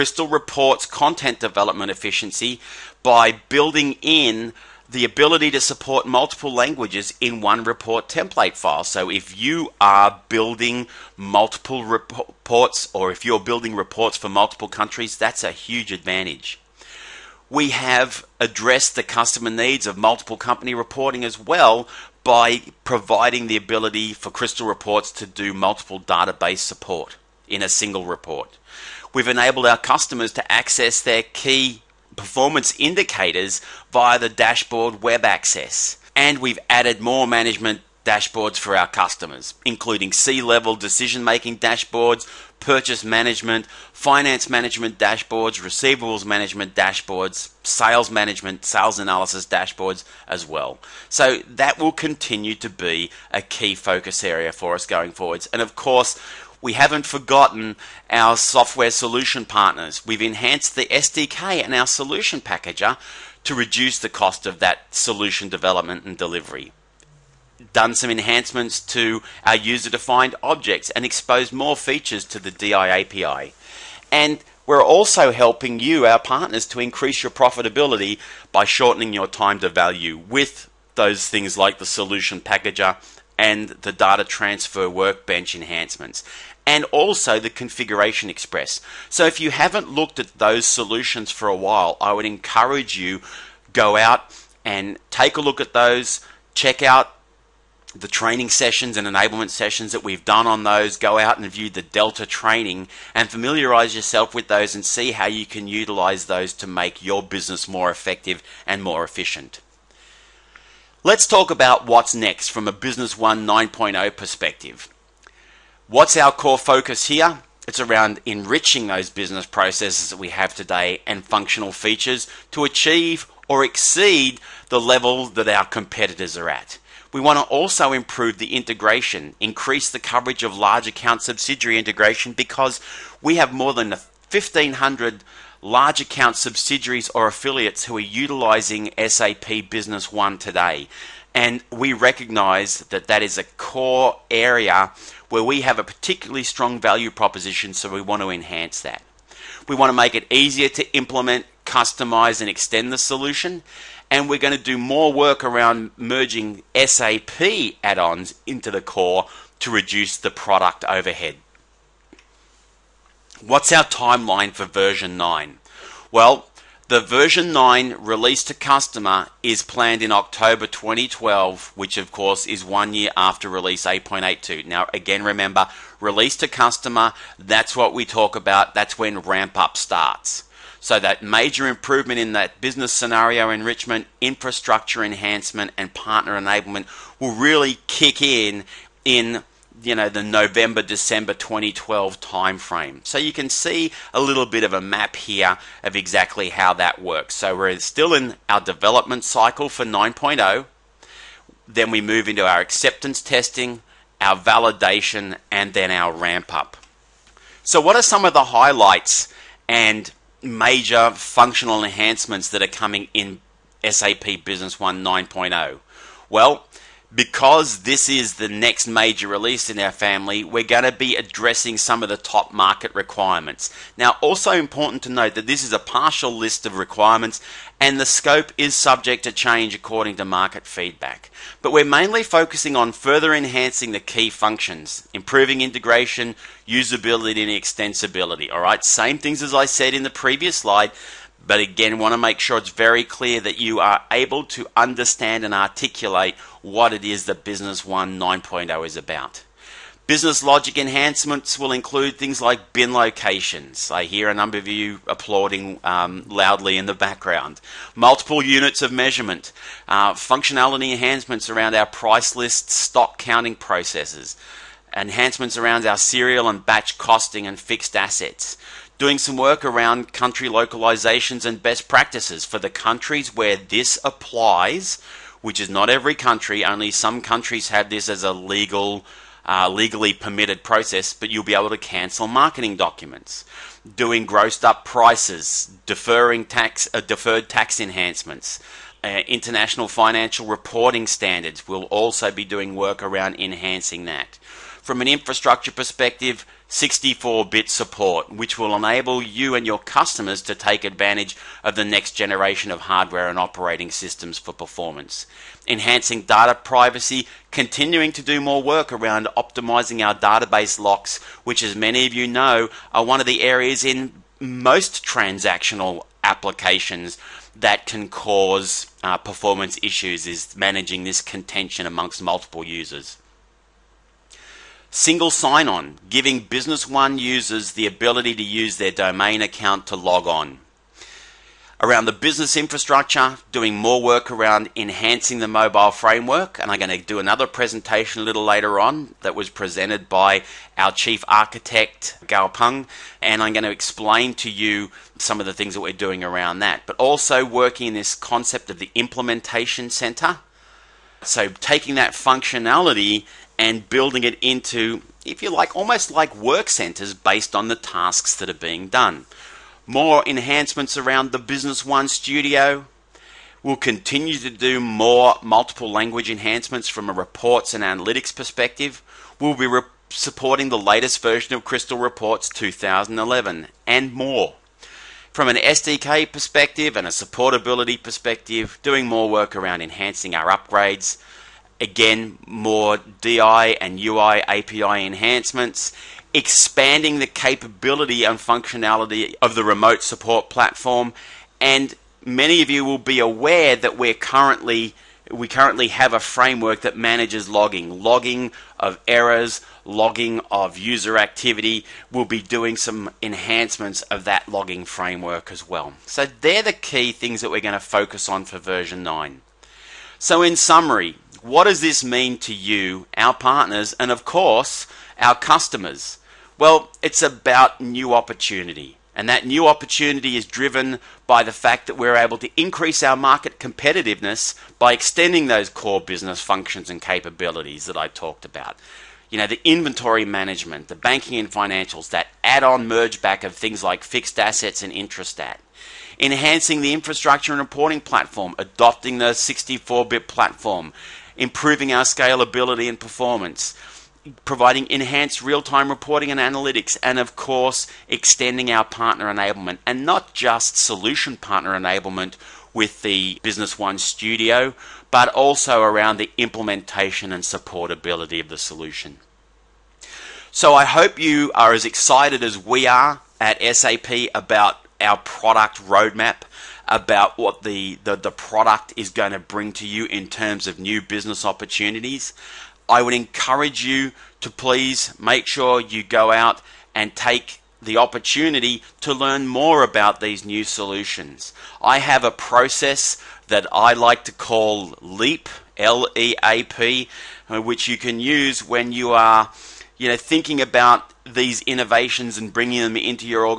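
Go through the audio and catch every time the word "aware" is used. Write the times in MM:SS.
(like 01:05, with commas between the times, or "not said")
06:33.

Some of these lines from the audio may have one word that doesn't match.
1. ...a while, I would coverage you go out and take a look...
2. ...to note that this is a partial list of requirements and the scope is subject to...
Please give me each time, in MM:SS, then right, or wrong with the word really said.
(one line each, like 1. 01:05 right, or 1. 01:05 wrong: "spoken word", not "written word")
1. 01:31 wrong: "encourage", not "coverage"
2. 03:45 right.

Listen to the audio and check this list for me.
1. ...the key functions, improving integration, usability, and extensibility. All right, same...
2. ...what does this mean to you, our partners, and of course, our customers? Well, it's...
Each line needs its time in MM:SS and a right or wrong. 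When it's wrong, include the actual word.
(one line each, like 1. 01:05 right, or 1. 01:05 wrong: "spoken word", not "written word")
1. 03:53 right
2. 06:51 right.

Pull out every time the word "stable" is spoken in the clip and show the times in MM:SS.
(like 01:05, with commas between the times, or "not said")
not said.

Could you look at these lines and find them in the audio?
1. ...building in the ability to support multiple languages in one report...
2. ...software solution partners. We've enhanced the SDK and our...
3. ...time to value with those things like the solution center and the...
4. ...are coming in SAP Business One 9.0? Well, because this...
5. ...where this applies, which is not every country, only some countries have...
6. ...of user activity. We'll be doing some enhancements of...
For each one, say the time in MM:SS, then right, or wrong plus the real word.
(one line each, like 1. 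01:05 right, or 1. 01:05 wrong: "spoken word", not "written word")
1. 00:03 right
2. 00:58 right
3. 01:19 wrong: "packager", not "center"
4. 03:32 right
5. 04:33 right
6. 06:40 right.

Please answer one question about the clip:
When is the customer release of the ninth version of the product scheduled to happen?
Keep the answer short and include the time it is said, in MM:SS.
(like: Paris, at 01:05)
October 2012, at 02:50.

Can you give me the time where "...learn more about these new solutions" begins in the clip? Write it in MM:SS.
07:59.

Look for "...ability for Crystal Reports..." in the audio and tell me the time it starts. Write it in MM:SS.
00:23.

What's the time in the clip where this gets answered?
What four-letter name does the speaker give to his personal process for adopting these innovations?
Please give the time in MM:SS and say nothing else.
08:05.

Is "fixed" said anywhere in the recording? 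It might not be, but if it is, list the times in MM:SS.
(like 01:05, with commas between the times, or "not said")
04:27, 07:14.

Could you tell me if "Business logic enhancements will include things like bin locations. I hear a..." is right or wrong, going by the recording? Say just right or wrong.
right.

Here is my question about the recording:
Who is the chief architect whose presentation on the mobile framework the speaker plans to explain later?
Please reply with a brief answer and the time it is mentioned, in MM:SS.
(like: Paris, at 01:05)
Gao Peng, at 05:42.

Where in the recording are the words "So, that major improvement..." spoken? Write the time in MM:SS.
03:00.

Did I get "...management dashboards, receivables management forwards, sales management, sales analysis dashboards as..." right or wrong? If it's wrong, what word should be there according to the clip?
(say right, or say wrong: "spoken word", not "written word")
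wrong: "dashboards", not "forwards".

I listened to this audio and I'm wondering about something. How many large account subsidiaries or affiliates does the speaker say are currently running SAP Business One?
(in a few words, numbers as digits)
more than 1,500.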